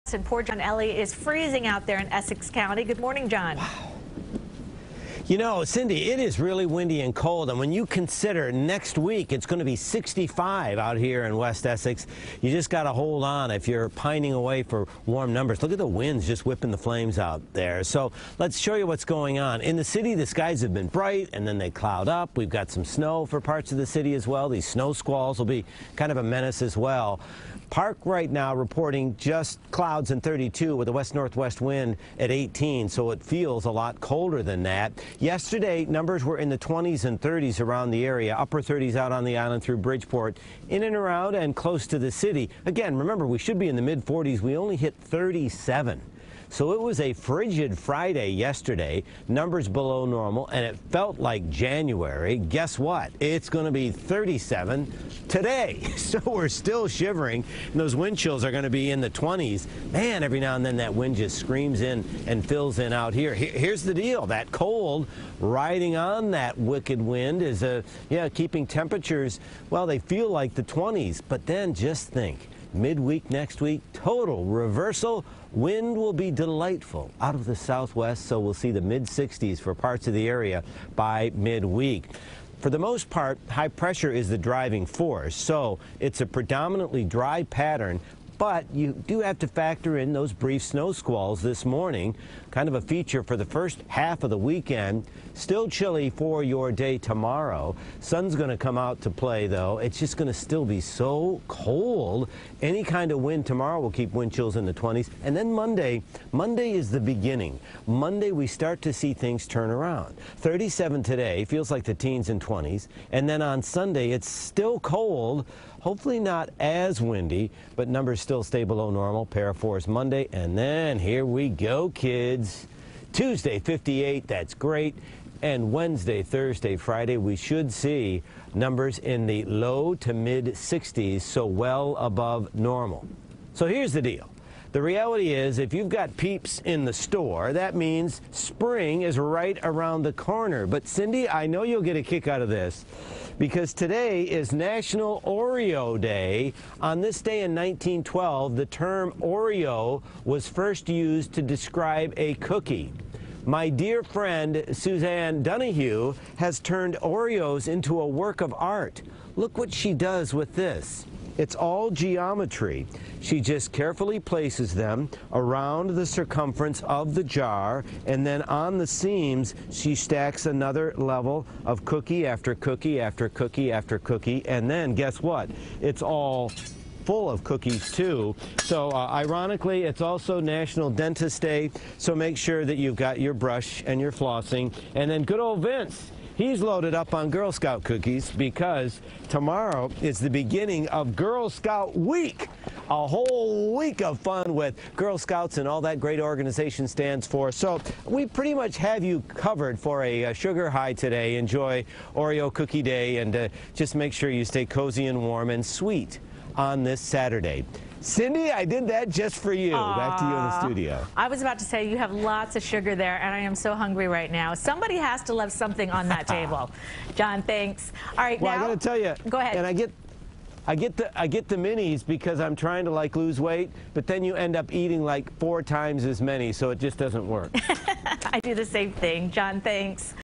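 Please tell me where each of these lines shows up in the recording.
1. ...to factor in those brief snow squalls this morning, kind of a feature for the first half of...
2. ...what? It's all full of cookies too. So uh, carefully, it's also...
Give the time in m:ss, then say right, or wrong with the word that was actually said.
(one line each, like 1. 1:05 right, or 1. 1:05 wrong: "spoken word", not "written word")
1. 1:29 right
2. 2:55 wrong: "ironically", not "carefully".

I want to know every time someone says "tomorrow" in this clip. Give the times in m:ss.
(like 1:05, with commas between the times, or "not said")
1:36, 1:43, 3:09.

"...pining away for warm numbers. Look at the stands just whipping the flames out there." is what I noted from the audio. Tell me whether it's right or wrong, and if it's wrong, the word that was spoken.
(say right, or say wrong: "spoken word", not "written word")
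wrong: "winds", not "stands".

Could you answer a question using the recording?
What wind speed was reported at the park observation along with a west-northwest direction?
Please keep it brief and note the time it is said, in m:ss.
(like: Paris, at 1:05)
18, at 0:32.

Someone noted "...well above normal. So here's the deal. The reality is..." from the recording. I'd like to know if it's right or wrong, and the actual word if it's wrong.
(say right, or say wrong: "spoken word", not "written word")
right.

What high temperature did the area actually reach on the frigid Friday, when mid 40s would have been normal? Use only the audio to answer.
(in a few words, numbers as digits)
37.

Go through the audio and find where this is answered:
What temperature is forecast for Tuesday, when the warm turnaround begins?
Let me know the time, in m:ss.
2:03.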